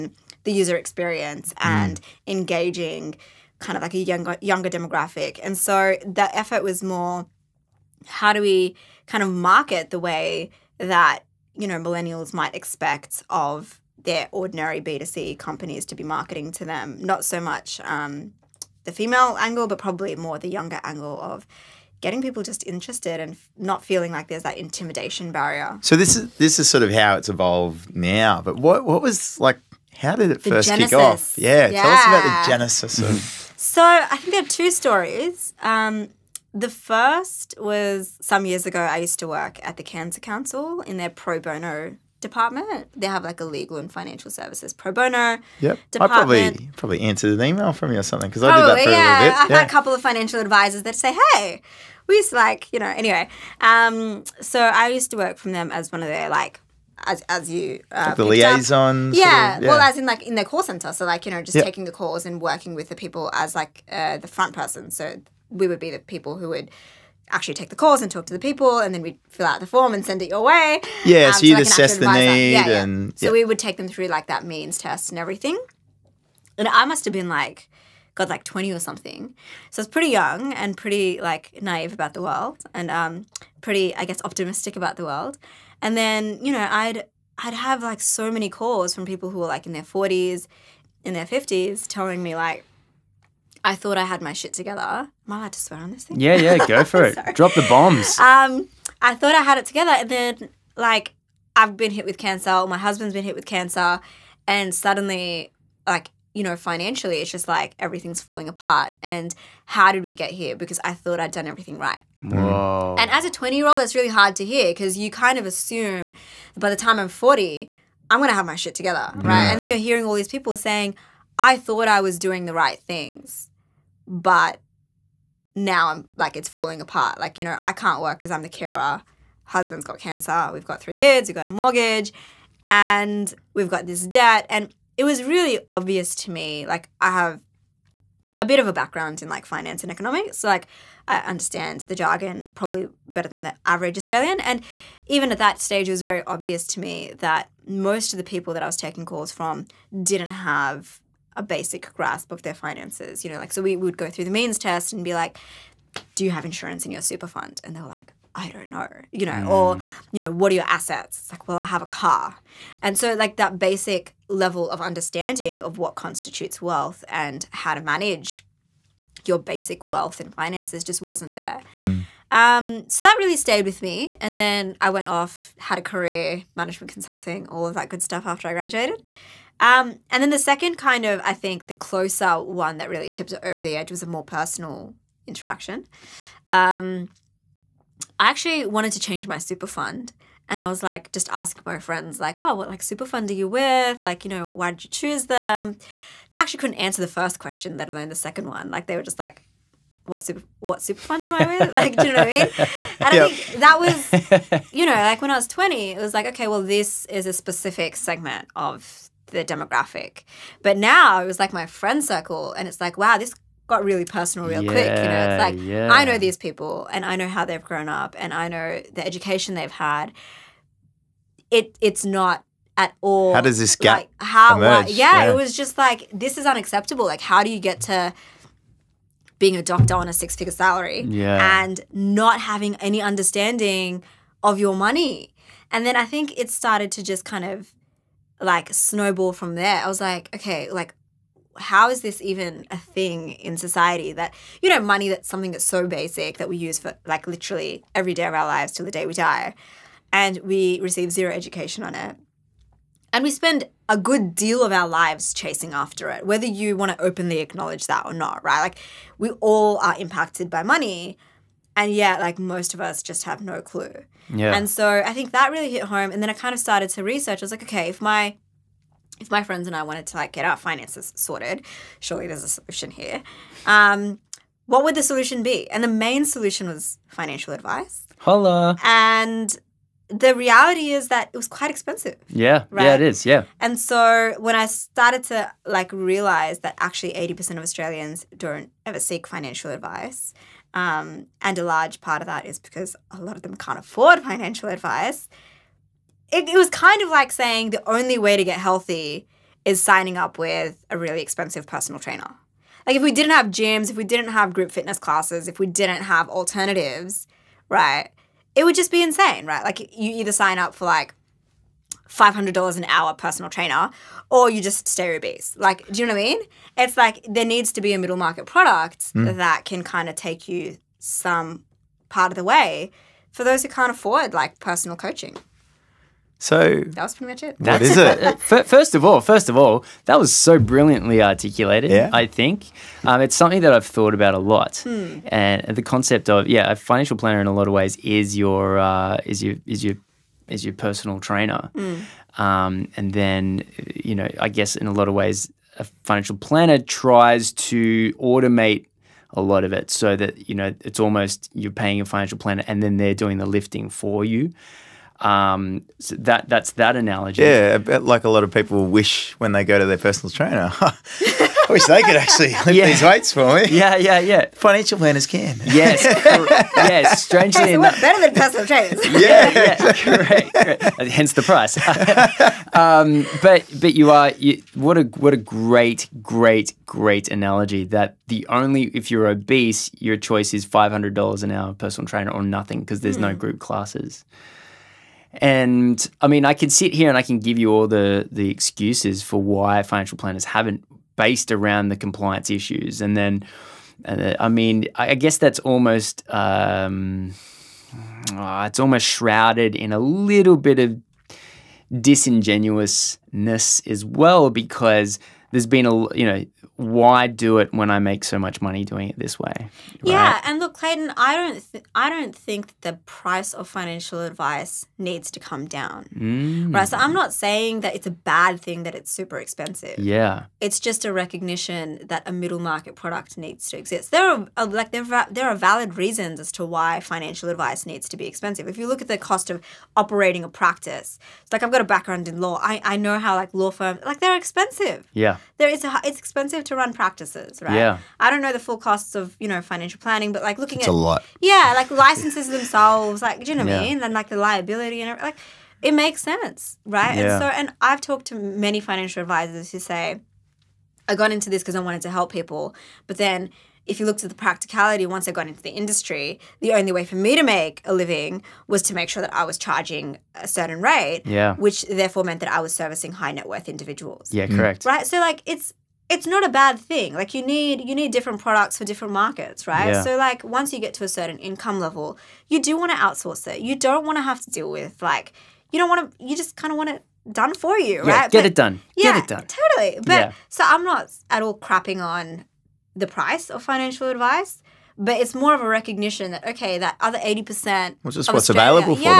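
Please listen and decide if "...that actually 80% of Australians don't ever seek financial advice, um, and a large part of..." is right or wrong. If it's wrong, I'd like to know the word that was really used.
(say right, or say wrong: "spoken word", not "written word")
right.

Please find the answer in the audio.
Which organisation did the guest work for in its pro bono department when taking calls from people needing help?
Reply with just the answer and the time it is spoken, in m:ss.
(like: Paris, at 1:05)
Cancer Council, at 0:39.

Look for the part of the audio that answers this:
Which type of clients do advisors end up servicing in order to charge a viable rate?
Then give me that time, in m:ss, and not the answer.
7:43.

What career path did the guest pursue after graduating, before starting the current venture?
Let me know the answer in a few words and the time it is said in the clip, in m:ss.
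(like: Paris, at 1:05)
management consulting, at 2:56.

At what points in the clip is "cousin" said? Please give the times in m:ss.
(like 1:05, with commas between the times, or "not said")
not said.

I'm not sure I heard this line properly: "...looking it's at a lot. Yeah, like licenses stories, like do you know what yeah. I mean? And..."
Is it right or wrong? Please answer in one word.
wrong.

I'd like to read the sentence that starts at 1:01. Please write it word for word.
taking the calls and working with the people as like uh, the front person.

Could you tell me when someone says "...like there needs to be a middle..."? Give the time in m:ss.
5:16.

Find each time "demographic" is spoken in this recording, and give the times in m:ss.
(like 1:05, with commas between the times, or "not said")
0:04, 3:29.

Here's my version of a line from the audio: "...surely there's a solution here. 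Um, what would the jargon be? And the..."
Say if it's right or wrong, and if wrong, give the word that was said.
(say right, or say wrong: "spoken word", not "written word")
wrong: "solution", not "jargon".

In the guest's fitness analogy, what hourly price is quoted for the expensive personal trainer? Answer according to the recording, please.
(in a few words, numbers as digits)
$500.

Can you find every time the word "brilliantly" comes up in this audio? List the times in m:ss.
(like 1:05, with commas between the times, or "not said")
5:30.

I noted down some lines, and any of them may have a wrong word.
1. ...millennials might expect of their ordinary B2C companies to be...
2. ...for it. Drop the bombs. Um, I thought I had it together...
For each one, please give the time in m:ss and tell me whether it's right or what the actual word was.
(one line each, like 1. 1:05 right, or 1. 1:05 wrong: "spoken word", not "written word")
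1. 0:11 right
2. 1:36 right.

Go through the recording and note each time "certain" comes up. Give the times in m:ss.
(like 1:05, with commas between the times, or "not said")
7:40, 7:51.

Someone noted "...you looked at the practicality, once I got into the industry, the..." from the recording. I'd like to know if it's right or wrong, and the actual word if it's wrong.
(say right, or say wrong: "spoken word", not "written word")
right.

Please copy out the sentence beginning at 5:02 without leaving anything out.
Like if we didn't have gyms, if we didn't have group fitness classes, if we didn't have alternatives, right?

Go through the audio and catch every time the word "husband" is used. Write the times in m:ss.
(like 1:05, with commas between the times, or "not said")
1:42, 2:09.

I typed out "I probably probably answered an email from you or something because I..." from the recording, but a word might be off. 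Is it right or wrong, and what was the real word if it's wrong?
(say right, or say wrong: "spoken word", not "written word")
right.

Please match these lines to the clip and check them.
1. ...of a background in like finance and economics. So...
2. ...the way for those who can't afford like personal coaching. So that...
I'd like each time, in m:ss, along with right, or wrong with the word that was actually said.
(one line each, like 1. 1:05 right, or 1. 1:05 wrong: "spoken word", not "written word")
1. 2:18 right
2. 5:22 right.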